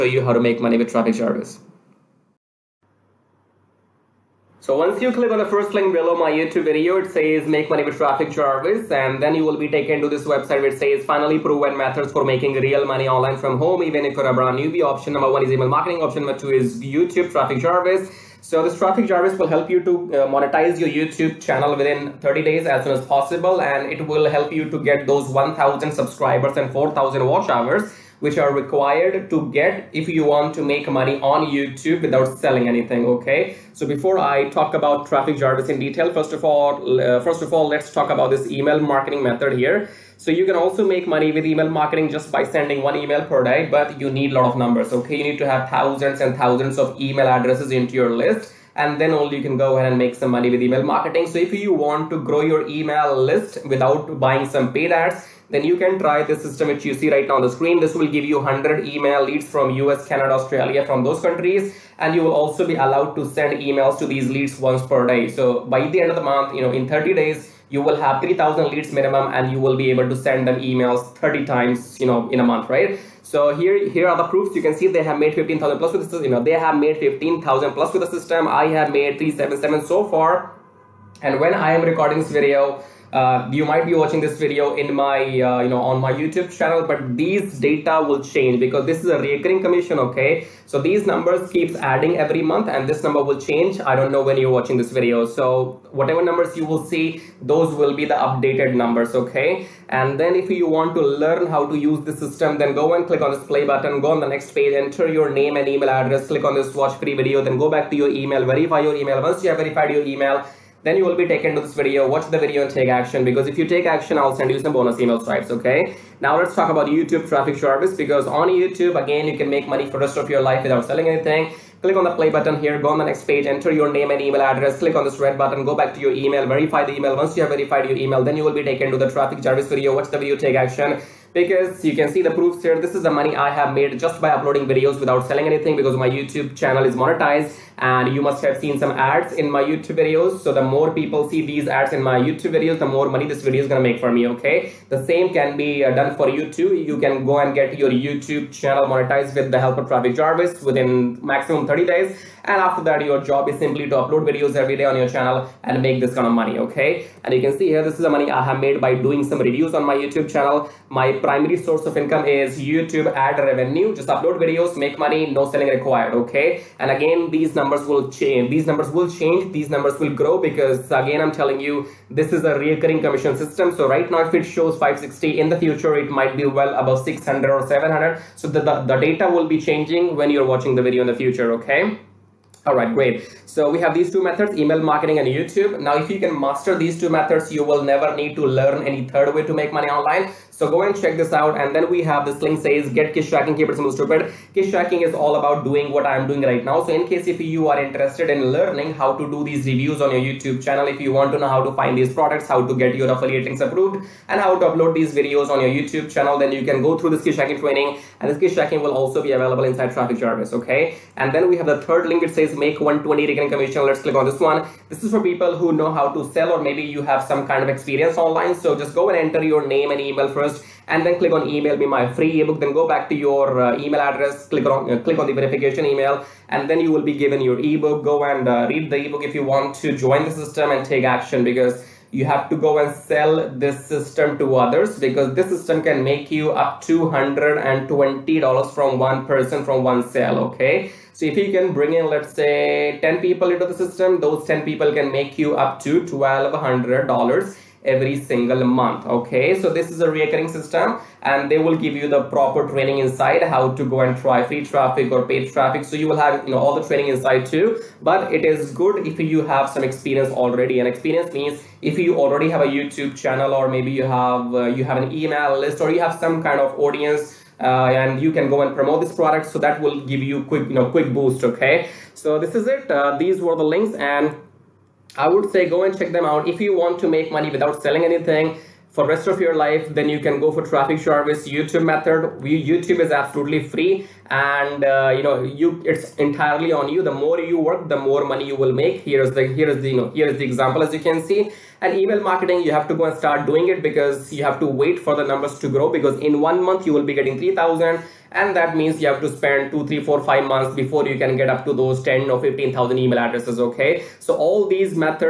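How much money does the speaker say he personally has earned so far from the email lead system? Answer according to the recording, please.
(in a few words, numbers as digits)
377.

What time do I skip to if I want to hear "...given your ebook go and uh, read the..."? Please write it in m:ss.
3:47.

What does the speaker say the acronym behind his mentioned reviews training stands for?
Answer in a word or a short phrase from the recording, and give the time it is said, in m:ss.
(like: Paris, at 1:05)
Keep it simple stupid, at 3:13.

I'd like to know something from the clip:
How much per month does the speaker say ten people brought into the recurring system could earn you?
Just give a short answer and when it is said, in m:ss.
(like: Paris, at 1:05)
$1200, at 4:06.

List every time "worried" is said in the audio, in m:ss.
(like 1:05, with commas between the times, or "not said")
not said.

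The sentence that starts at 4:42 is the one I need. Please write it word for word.
YouTube is absolutely free, and uh, you know you it's entirely on you.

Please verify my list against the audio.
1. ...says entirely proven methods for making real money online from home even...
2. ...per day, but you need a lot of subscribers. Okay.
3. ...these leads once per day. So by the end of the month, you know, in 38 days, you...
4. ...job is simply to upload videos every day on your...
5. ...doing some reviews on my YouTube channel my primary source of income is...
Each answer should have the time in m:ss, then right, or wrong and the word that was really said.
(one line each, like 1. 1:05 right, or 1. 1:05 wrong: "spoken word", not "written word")
1. 0:10 wrong: "finally", not "entirely"
2. 0:43 wrong: "numbers", not "subscribers"
3. 1:04 wrong: "30", not "38"
4. 2:33 right
5. 2:38 right.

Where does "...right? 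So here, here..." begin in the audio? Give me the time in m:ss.
1:12.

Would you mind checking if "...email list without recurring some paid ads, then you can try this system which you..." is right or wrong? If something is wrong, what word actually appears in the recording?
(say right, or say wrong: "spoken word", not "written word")
wrong: "buying", not "recurring".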